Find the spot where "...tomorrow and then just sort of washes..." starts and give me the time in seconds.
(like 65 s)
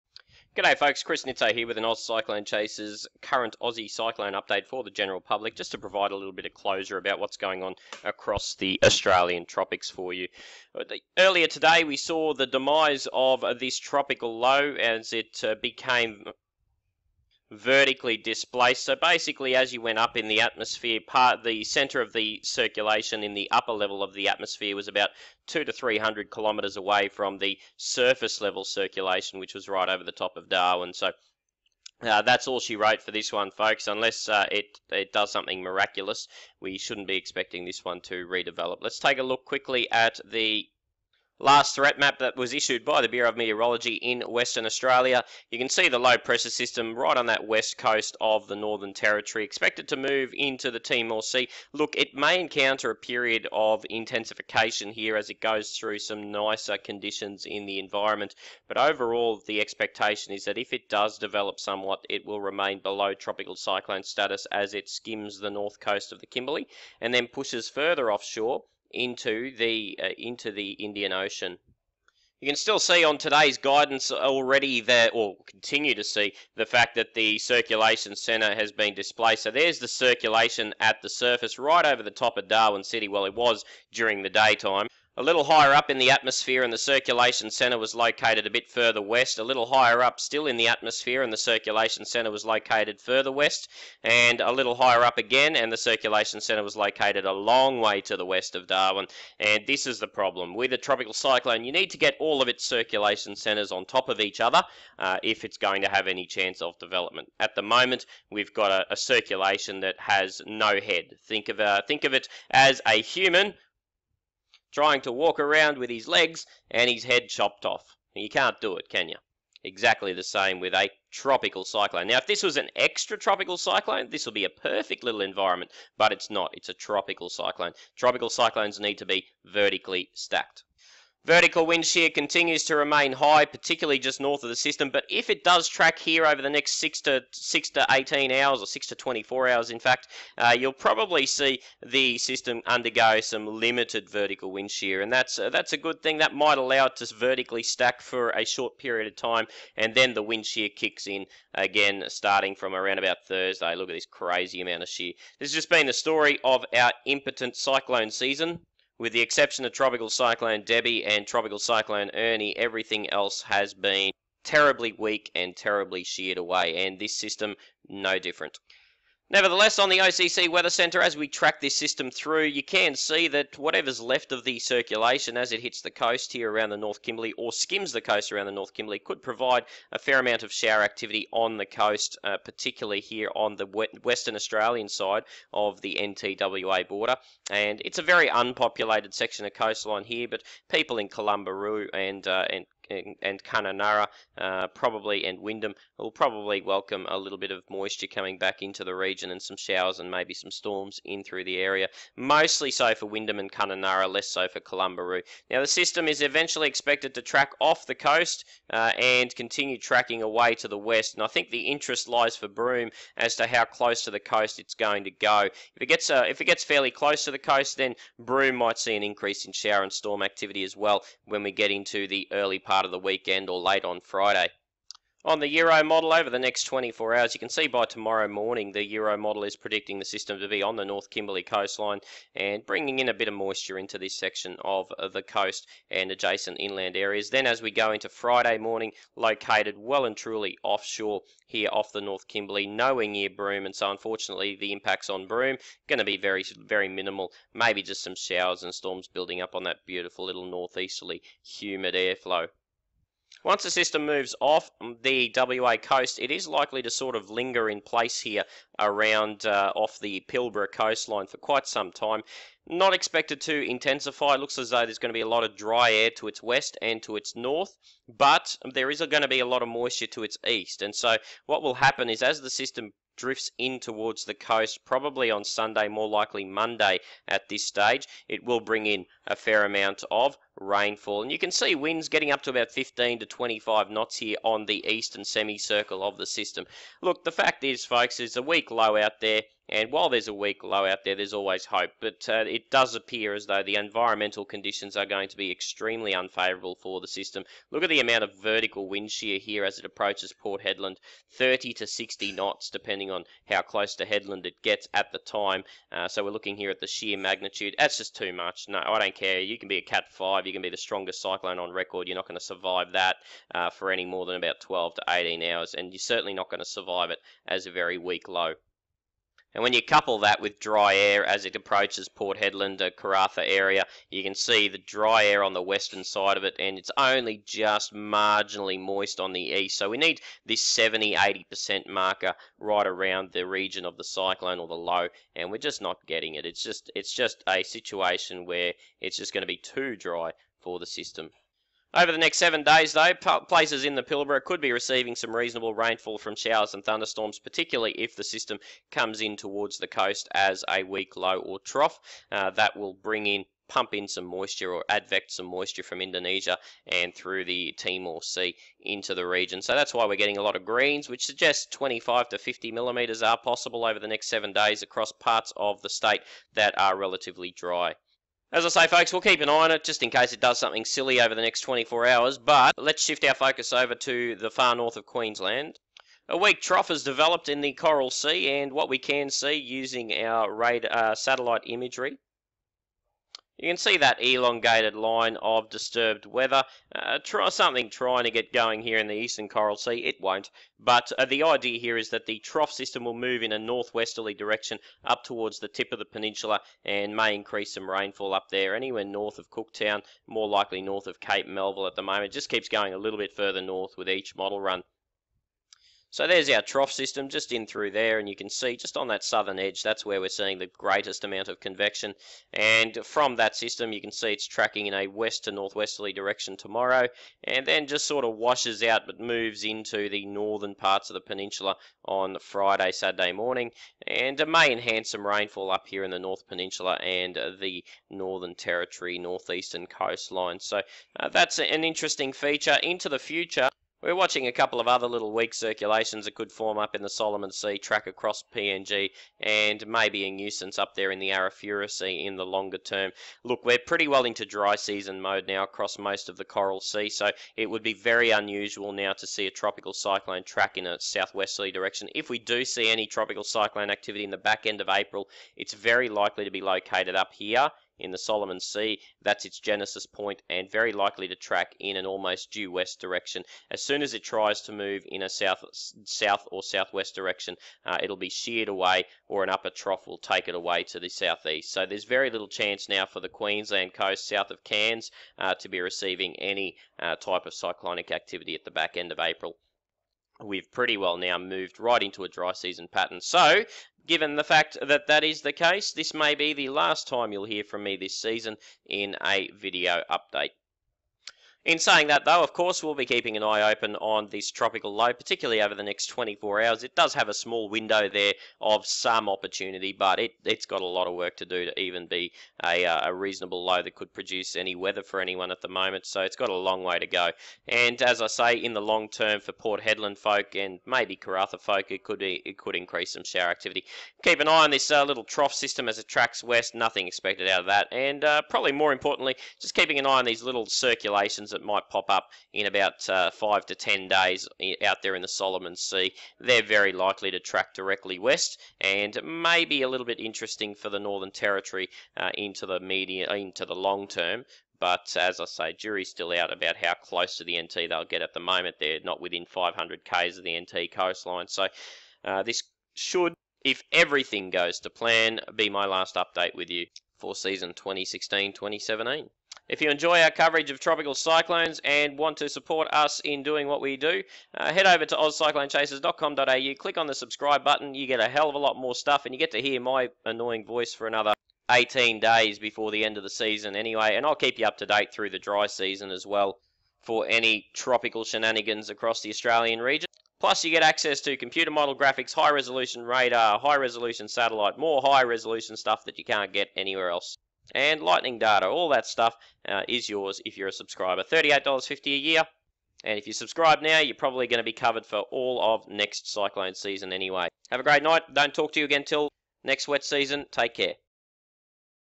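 416 s.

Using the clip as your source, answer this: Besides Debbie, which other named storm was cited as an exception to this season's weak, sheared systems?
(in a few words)
Ernie.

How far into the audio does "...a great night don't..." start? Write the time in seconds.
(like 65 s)
587 s.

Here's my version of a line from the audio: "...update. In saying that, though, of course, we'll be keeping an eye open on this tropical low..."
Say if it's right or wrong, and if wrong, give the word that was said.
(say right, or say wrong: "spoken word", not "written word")
right.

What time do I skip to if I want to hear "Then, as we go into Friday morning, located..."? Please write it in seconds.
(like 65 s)
237 s.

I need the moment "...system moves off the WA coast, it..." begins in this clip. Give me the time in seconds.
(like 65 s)
253 s.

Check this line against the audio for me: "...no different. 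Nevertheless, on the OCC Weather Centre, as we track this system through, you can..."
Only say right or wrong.
right.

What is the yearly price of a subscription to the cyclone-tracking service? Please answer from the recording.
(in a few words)
$38.50.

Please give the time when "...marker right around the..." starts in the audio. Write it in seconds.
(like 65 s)
331 s.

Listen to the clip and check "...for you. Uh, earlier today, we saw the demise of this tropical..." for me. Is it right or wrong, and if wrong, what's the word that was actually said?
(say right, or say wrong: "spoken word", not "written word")
right.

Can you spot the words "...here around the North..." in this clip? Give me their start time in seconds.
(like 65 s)
176 s.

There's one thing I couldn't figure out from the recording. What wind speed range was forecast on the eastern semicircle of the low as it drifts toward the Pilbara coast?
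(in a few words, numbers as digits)
15 to 25 knots.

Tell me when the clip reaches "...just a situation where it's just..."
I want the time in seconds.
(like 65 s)
337 s.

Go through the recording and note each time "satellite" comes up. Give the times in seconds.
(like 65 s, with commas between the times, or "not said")
381 s, 574 s.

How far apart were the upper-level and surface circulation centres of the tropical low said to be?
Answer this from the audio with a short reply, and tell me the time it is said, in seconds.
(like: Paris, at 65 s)
200 to 300 kilometres, at 25 s.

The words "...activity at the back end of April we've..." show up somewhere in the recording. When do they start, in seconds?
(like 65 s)
478 s.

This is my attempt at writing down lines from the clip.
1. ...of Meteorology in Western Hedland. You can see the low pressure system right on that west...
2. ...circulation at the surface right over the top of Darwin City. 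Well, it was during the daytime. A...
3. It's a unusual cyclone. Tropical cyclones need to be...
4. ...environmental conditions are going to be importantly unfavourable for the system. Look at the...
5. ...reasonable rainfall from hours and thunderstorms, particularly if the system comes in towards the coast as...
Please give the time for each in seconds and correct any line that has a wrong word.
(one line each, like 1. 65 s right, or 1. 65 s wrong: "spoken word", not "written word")
1. 43 s wrong: "Australia", not "Hedland"
2. 79 s right
3. 126 s wrong: "tropical", not "unusual"
4. 293 s wrong: "extremely", not "importantly"
5. 345 s wrong: "showers", not "hours".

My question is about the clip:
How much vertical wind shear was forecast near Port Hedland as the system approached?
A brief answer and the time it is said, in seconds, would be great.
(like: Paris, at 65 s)
30 to 60 knots, at 301 s.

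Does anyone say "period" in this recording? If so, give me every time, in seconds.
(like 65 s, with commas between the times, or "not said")
52 s, 148 s.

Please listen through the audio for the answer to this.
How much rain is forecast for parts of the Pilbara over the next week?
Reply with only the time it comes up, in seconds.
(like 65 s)
361 s.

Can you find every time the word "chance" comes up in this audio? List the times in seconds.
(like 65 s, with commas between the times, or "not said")
106 s, 472 s.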